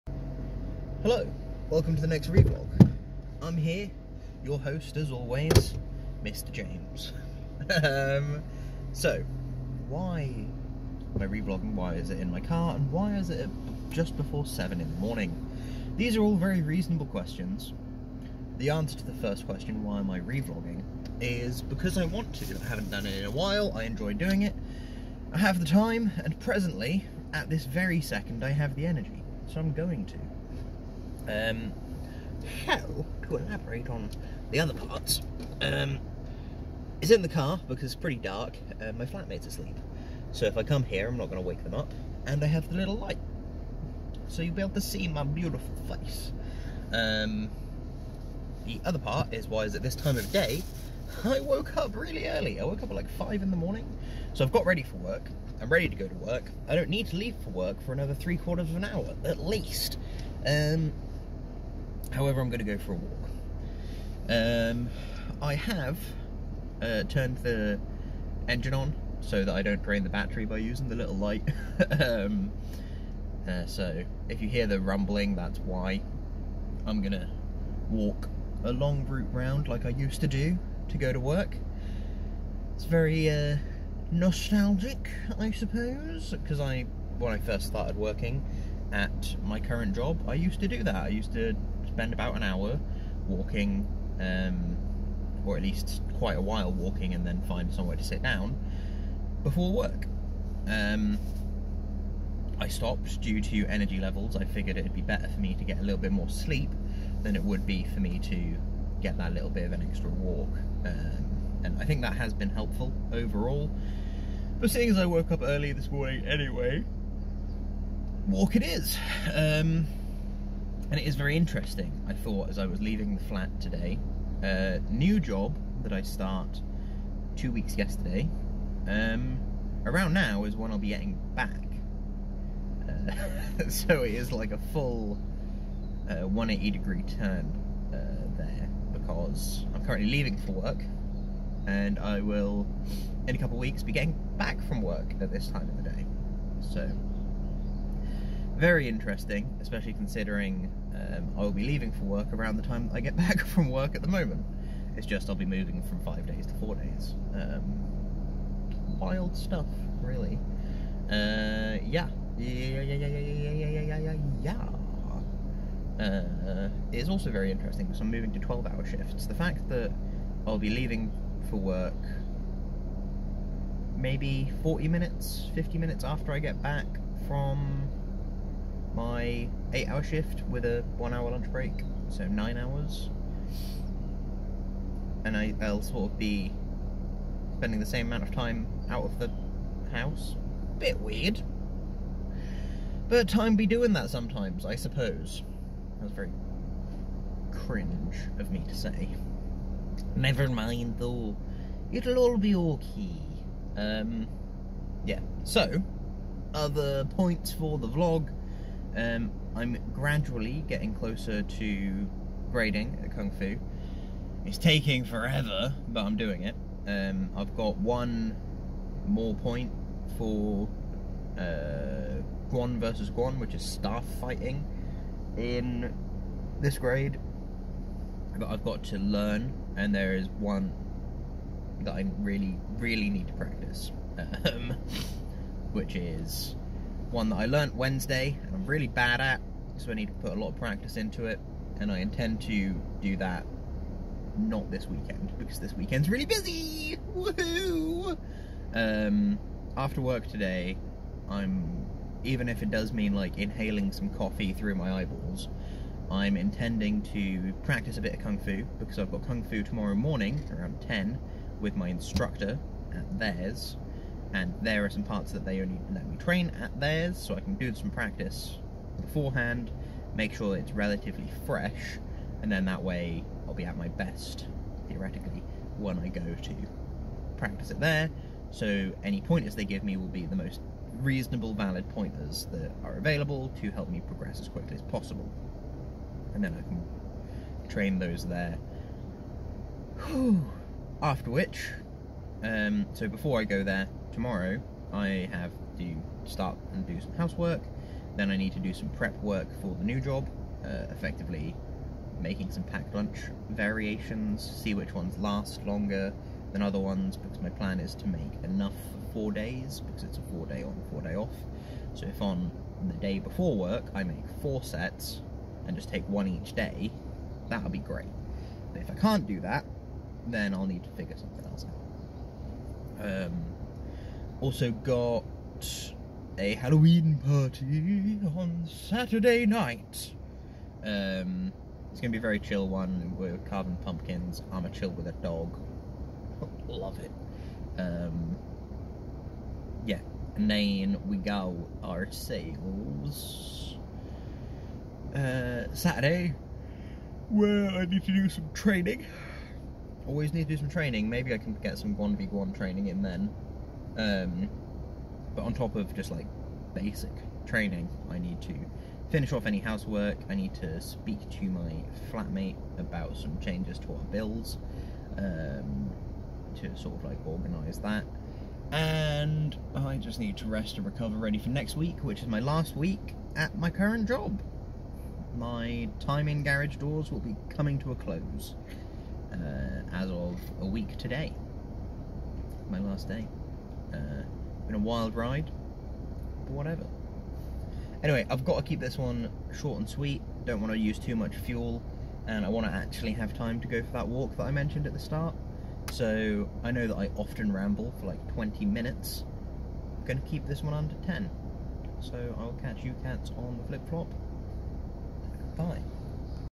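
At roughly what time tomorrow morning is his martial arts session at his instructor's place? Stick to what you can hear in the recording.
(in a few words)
around 10.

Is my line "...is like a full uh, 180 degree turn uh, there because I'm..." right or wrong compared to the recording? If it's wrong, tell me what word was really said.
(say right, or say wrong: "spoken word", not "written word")
right.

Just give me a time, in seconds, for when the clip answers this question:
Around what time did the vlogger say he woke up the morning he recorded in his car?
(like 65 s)
53 s.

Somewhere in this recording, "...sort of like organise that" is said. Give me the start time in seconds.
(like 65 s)
366 s.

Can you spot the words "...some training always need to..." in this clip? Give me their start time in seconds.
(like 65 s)
348 s.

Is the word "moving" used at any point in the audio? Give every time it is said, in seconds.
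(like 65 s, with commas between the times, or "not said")
155 s, 168 s.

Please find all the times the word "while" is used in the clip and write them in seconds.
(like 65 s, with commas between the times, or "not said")
23 s, 96 s.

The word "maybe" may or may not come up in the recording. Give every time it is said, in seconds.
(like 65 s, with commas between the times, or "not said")
173 s, 351 s.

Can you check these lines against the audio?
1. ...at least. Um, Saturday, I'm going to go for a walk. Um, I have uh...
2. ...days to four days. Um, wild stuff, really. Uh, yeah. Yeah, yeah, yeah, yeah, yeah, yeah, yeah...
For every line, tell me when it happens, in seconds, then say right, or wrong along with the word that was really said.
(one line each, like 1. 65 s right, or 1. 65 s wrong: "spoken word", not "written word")
1. 59 s wrong: "However", not "Saturday"
2. 156 s right.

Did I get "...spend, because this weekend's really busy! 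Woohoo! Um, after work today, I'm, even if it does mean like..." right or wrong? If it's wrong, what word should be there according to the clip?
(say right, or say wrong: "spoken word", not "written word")
wrong: "weekend", not "spend".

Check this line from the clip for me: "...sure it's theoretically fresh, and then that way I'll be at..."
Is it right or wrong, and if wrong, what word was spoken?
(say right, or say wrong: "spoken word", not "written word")
wrong: "relatively", not "theoretically".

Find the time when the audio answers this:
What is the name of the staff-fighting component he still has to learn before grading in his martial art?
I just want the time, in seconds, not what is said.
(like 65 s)
222 s.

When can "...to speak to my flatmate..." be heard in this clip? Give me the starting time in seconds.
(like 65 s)
360 s.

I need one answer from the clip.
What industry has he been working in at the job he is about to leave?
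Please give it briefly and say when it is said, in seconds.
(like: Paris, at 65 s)
garage doors, at 376 s.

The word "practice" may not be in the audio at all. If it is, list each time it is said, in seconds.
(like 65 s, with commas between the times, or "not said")
233 s, 240 s, 257 s, 267 s, 277 s.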